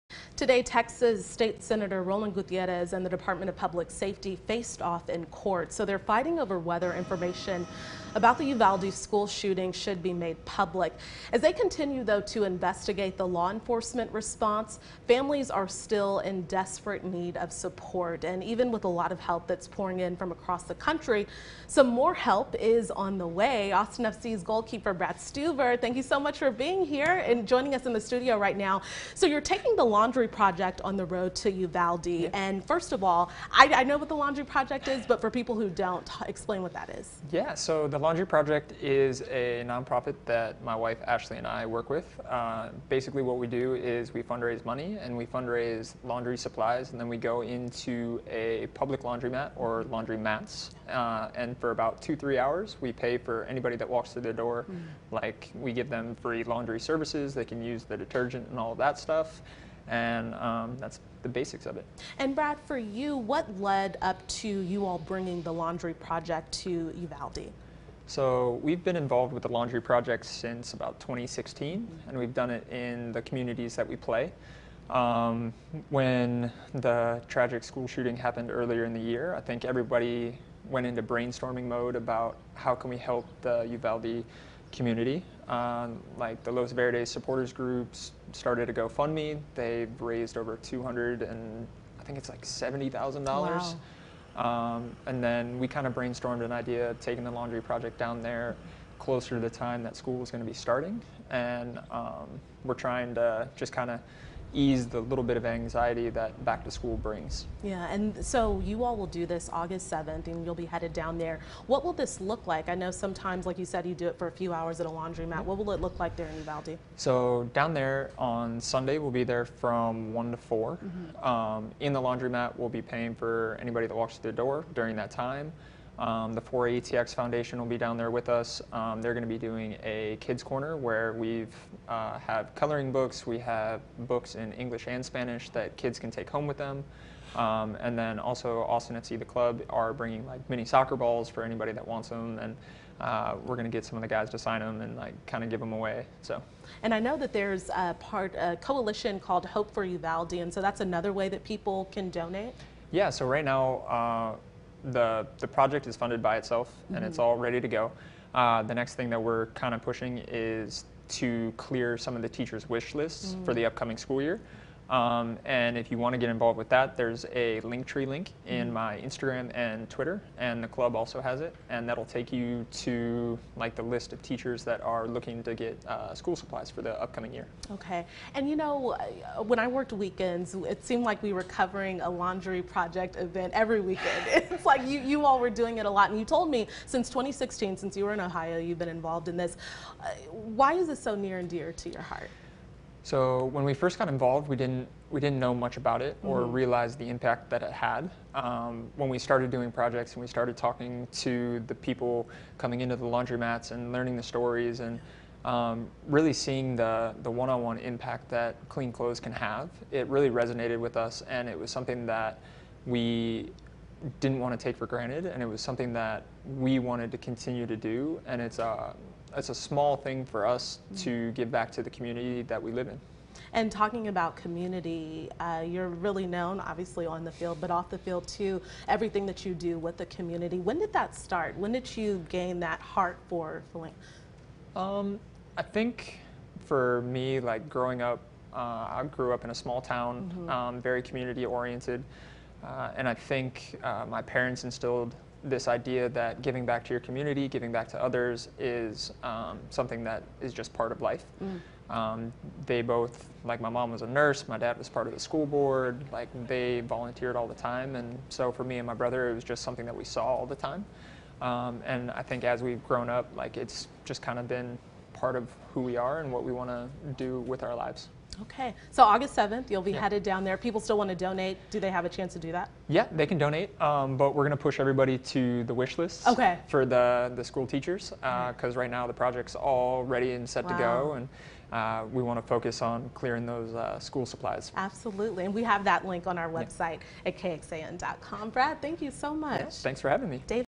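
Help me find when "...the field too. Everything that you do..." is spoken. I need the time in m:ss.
3:47.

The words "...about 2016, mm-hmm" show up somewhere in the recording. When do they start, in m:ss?
1:10.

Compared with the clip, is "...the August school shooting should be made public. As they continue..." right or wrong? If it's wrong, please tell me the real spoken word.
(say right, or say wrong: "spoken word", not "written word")
wrong: "Uvalde", not "August".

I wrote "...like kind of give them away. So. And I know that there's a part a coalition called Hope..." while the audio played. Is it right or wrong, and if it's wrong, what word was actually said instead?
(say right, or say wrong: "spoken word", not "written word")
right.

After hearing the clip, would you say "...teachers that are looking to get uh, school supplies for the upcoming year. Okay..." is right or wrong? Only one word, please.
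right.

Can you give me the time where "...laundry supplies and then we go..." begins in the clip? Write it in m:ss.
0:46.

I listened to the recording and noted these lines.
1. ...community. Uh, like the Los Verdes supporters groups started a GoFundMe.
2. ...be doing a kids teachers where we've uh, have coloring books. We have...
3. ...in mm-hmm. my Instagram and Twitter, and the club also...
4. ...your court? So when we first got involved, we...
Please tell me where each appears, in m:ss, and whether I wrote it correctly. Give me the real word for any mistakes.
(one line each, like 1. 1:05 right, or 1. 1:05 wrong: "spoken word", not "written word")
1. 1:24 right
2. 2:09 wrong: "corner", not "teachers"
3. 2:48 right
4. 3:11 wrong: "heart", not "court".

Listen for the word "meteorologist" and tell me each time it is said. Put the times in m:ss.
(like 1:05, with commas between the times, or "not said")
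not said.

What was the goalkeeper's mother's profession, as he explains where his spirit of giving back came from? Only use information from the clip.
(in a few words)
nurse.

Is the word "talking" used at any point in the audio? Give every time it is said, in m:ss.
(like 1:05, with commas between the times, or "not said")
3:20, 3:43.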